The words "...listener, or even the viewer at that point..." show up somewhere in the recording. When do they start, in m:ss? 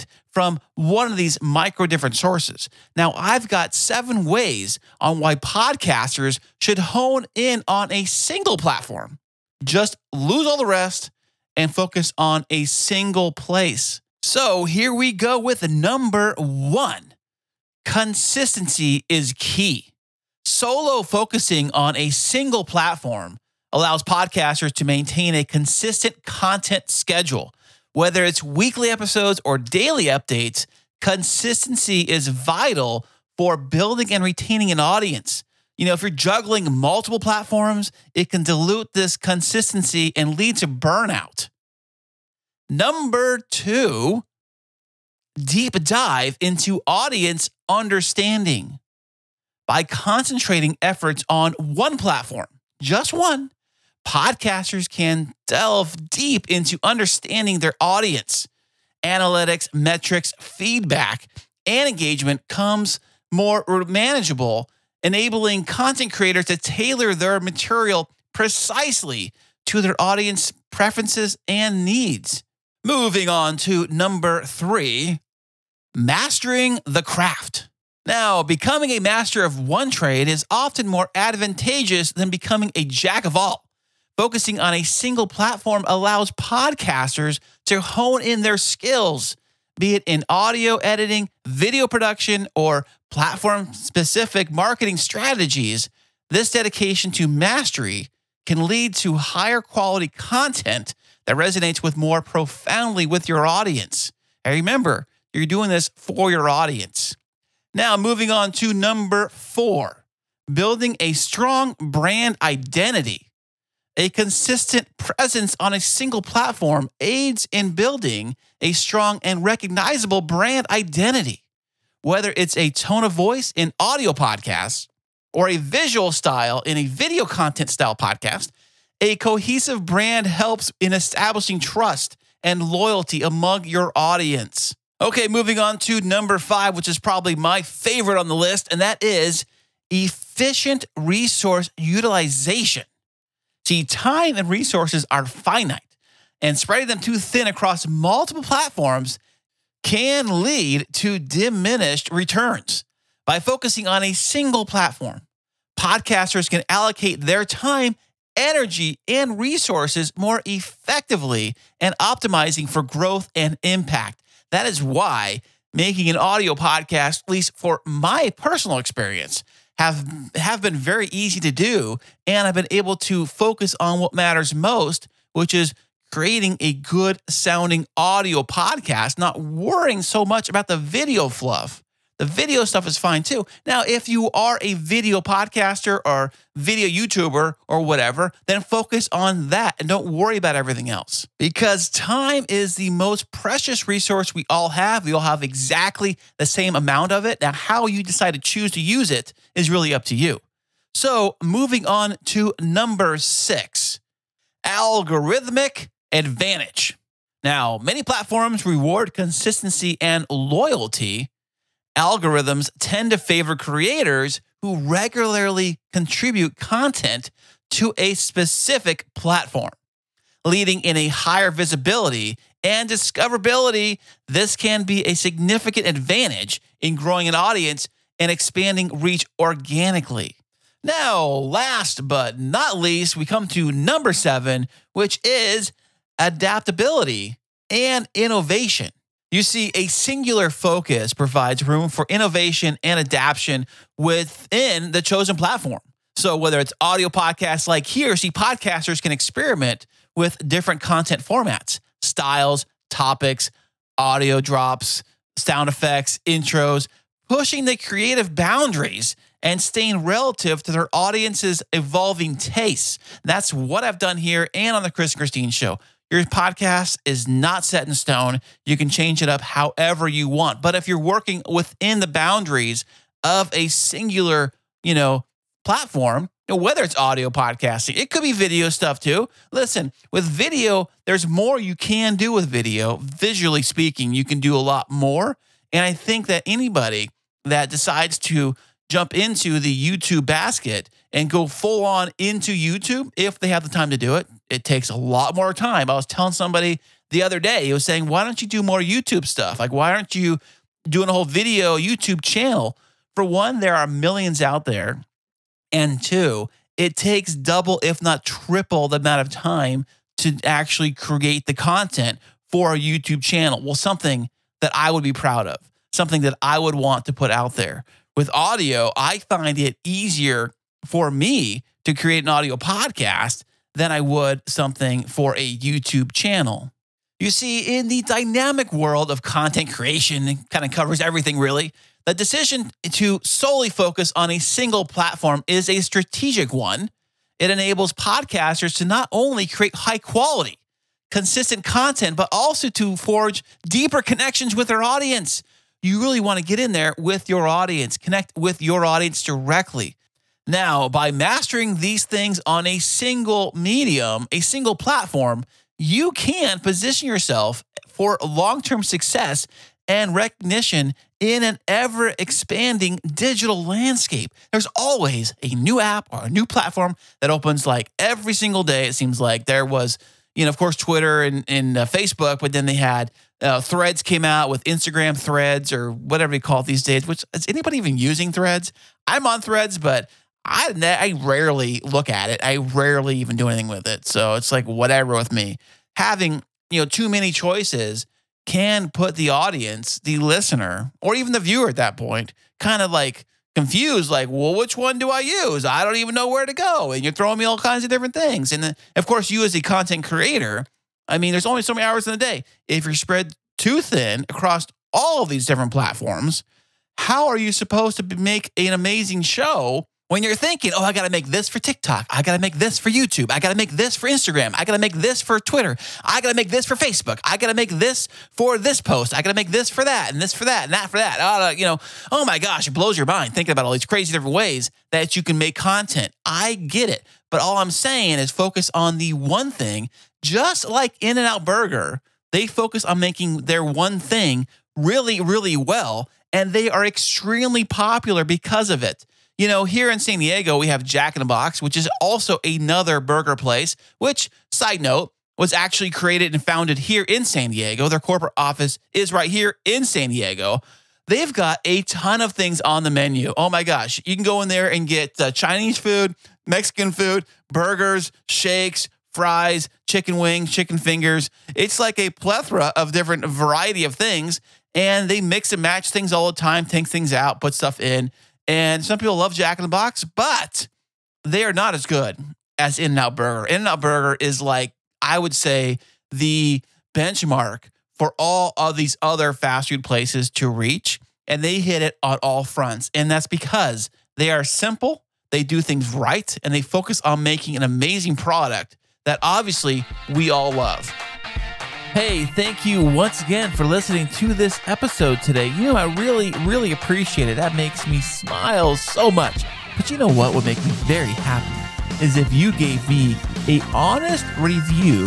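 6:30.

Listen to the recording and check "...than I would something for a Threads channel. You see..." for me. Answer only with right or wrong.
wrong.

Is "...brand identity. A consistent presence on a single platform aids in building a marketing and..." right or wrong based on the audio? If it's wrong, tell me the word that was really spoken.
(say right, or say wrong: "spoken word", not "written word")
wrong: "strong", not "marketing".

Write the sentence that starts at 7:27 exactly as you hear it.
Their corporate office is right here in San Diego.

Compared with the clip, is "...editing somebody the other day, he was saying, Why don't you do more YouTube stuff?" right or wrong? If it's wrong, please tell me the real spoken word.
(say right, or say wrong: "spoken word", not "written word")
wrong: "telling", not "editing".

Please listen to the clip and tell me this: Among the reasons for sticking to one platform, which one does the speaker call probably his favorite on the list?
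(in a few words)
Efficient resource utilization.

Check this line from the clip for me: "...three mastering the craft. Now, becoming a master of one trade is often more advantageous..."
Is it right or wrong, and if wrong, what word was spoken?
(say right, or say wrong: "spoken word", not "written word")
right.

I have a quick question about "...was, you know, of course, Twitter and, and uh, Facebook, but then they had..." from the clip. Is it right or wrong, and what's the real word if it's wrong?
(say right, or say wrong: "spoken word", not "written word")
right.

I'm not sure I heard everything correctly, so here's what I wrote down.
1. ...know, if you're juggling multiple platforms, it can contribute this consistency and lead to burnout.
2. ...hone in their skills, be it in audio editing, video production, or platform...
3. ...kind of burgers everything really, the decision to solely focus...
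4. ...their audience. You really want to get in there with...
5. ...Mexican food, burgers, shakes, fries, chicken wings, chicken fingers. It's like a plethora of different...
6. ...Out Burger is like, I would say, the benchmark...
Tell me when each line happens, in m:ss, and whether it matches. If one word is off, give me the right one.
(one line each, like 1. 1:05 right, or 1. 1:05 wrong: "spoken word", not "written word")
1. 0:35 wrong: "dilute", not "contribute"
2. 1:27 right
3. 5:30 wrong: "covers", not "burgers"
4. 5:44 right
5. 7:36 right
6. 7:53 right.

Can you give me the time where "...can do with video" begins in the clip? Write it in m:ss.
4:41.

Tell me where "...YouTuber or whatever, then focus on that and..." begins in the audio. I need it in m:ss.
3:06.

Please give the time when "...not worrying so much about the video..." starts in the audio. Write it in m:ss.
2:59.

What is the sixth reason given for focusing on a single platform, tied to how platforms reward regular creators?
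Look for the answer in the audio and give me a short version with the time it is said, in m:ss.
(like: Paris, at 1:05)
Algorithmic advantage, at 3:24.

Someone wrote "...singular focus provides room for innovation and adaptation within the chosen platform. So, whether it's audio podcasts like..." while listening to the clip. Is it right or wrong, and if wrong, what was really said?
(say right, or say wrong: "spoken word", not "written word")
right.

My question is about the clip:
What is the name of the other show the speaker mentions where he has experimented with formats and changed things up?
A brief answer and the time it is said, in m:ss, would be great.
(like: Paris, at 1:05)
The Chris and Christine Show, at 4:24.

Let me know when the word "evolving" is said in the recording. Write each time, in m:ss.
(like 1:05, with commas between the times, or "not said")
4:21.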